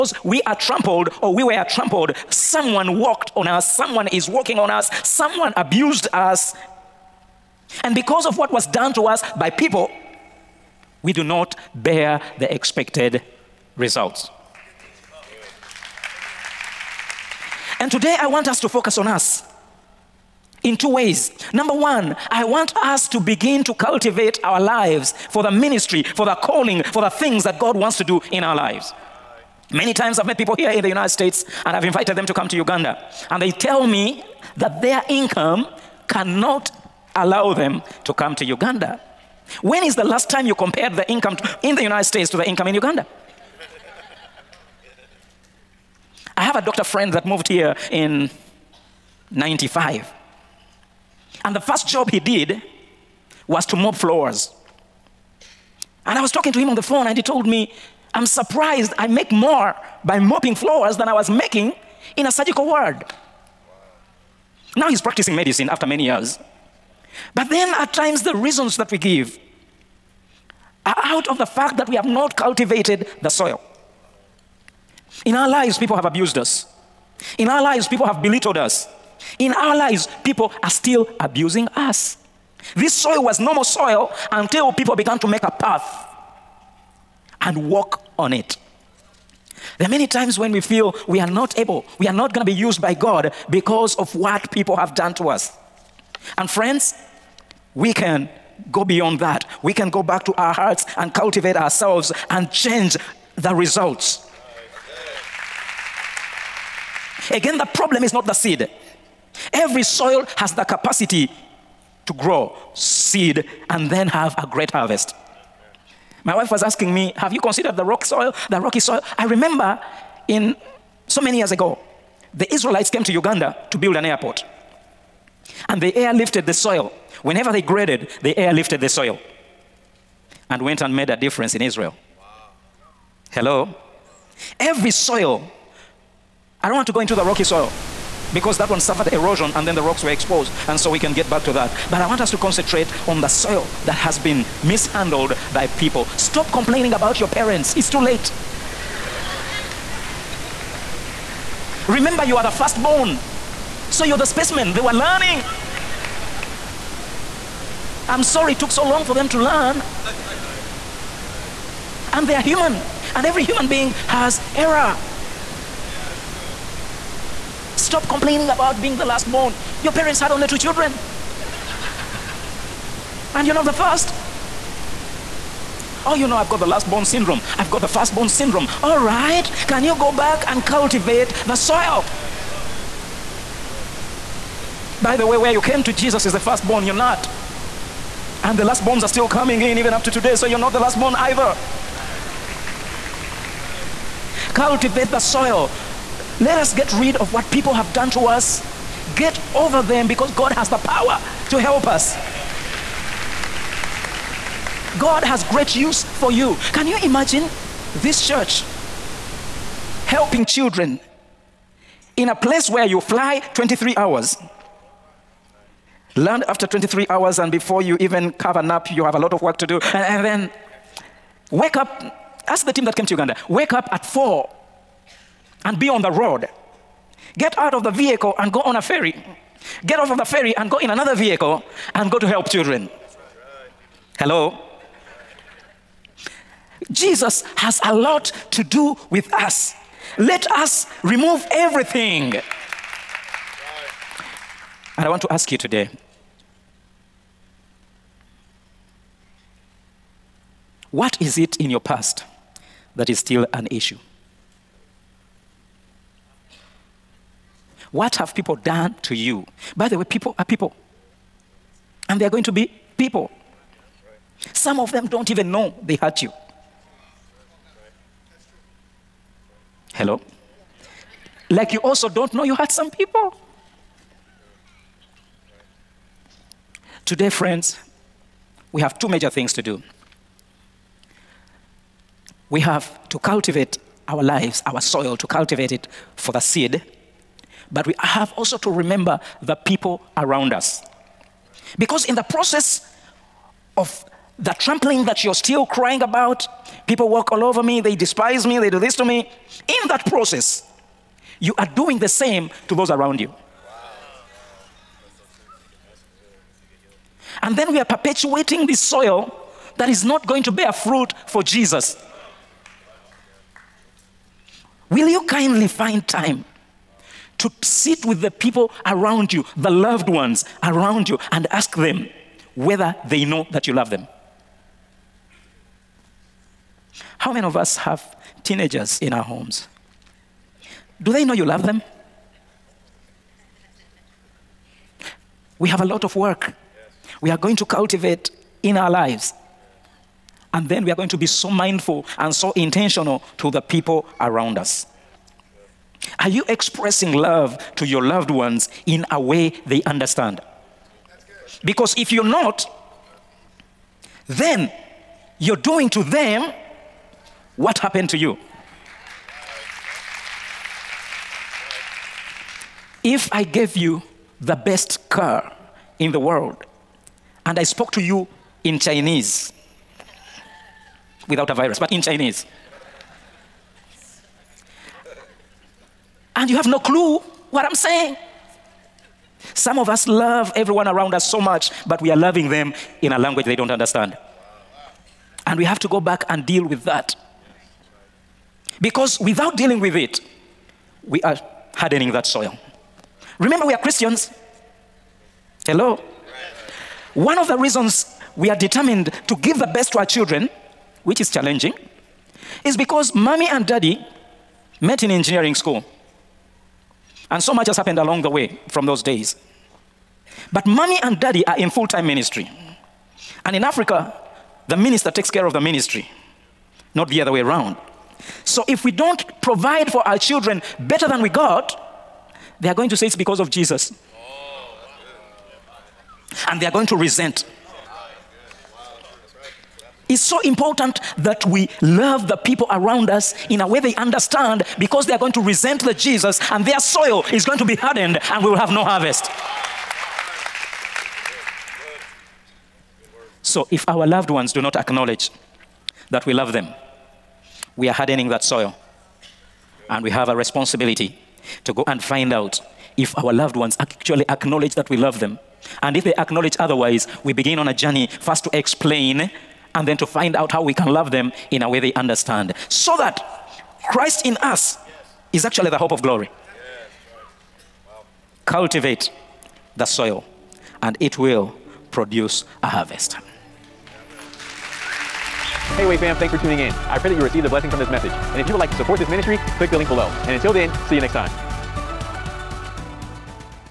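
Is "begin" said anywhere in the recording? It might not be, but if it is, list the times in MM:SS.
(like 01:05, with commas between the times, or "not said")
00:23, 07:37.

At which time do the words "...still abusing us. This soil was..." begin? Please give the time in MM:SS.
01:20.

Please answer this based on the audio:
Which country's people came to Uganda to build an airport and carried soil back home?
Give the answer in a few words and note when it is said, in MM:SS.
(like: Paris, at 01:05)
Israel, at 02:02.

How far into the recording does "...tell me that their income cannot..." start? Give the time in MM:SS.
00:33.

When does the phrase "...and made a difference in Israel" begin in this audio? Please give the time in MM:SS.
02:10.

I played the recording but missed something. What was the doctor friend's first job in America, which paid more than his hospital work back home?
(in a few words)
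Mopping floors.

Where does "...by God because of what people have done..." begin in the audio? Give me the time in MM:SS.
01:32.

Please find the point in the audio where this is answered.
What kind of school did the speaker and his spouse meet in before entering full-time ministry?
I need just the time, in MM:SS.
06:45.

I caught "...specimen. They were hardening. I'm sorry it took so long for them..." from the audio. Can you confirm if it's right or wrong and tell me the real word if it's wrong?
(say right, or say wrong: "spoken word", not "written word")
wrong: "learning", not "hardening".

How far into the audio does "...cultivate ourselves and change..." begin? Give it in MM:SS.
01:41.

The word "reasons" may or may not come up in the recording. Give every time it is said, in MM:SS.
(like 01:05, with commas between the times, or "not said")
01:08, 06:37.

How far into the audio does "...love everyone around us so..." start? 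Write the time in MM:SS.
06:20.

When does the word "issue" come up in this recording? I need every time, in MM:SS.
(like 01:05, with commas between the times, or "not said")
04:13.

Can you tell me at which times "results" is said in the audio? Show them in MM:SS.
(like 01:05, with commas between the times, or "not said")
00:13, 01:43.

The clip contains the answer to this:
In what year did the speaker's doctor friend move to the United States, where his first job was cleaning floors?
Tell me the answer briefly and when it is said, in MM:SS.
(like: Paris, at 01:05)
1995, at 00:49.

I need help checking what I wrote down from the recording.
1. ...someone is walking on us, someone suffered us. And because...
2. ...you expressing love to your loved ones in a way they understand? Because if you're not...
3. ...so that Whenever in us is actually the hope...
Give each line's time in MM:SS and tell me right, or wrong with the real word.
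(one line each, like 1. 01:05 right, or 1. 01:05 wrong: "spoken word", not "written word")
1. 00:03 wrong: "abused", not "suffered"
2. 05:46 right
3. 07:42 wrong: "Christ", not "Whenever".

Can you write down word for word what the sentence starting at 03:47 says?
Get out of the vehicle and go on a ferry.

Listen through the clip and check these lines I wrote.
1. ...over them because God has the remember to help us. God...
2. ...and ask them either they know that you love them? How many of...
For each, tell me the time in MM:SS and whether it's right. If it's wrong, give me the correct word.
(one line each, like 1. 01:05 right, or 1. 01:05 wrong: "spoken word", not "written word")
1. 03:19 wrong: "power", not "remember"
2. 05:21 wrong: "whether", not "either".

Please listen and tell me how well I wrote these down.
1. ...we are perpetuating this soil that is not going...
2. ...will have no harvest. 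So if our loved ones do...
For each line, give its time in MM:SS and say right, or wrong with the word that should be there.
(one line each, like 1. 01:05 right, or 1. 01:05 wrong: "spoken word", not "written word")
1. 05:07 right
2. 07:18 right.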